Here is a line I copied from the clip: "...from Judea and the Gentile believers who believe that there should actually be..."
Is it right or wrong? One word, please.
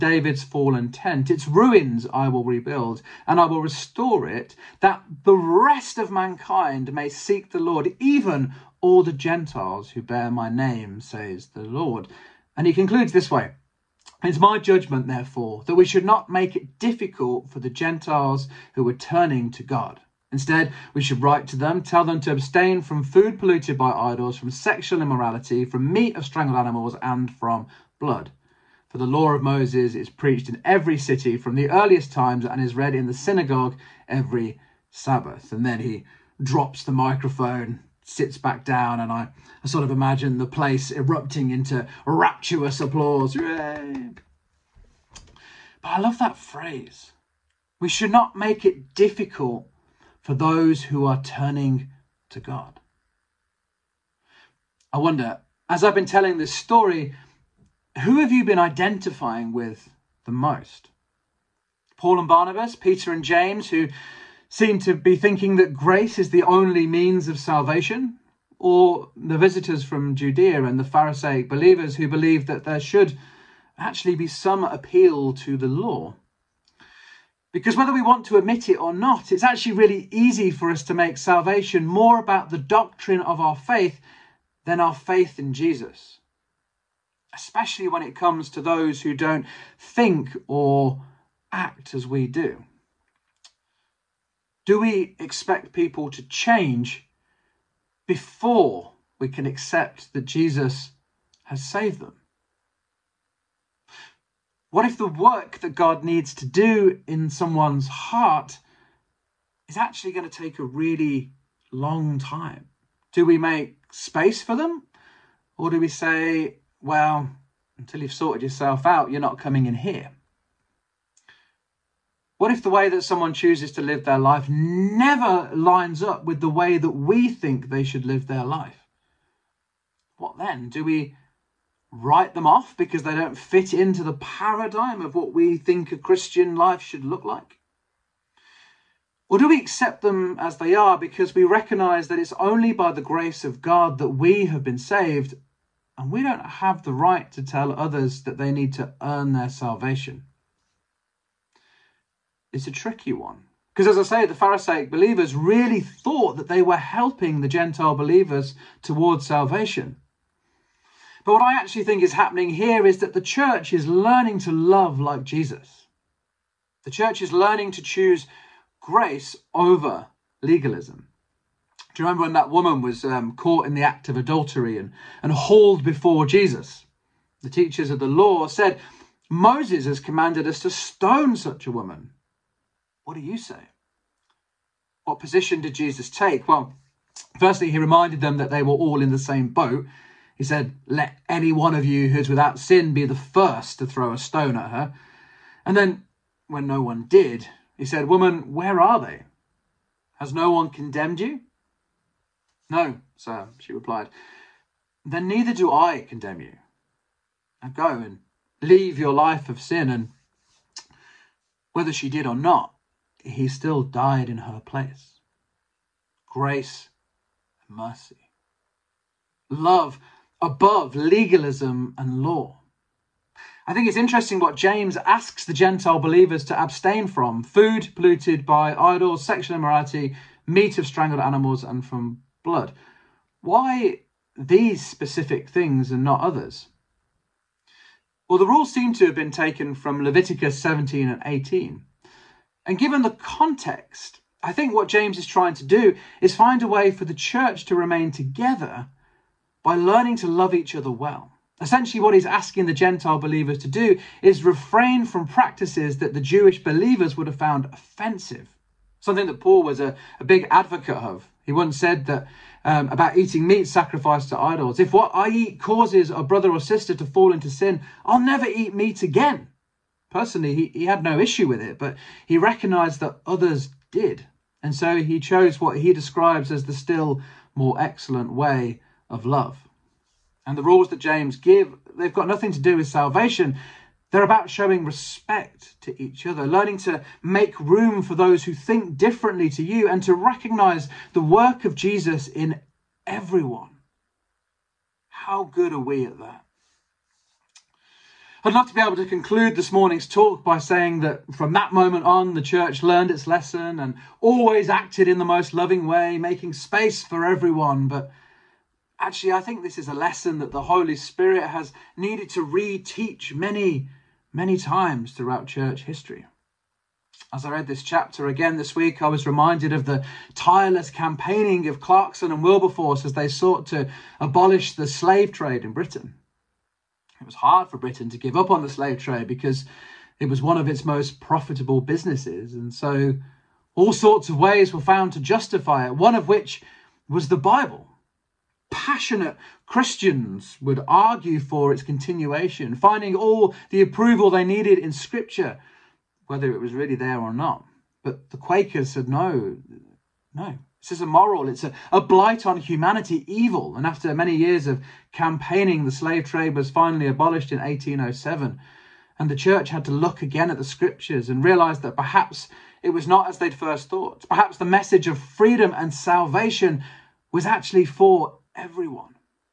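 wrong.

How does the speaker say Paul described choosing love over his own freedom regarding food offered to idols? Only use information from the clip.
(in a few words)
the still more excellent way.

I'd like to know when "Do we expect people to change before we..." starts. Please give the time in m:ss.
1:34.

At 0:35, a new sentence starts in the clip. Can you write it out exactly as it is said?
And then he drops the microphone, sits back down, and I, I sort of imagine the place erupting into rapturous applause.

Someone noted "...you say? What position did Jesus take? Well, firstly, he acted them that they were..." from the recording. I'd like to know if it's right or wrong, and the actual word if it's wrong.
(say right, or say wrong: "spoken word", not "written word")
wrong: "reminded", not "acted".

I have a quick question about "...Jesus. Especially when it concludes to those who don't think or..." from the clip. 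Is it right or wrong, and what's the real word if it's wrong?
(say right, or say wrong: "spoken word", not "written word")
wrong: "comes", not "concludes".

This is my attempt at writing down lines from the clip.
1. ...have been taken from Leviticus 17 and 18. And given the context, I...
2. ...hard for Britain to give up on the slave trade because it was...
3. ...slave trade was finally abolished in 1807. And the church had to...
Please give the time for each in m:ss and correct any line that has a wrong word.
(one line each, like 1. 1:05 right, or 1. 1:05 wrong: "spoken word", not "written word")
1. 3:59 right
2. 5:27 right
3. 5:55 right.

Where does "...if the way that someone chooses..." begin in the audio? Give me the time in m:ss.
2:02.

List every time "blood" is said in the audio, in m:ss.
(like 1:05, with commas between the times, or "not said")
0:27, 3:52.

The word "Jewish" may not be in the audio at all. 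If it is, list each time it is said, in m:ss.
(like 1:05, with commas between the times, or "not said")
4:16.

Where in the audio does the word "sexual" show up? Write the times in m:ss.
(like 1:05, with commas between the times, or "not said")
0:24, 3:49.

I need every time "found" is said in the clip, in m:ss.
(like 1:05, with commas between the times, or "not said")
4:17, 5:34.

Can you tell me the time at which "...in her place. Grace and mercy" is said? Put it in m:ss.
3:34.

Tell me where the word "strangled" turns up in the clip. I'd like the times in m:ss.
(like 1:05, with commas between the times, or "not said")
0:26, 3:50.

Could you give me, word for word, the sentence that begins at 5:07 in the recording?
But Actually, I think this is a lesson that the Holy Spirit has needed to reteach many, many times throughout church history.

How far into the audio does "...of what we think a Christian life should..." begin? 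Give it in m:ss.
2:15.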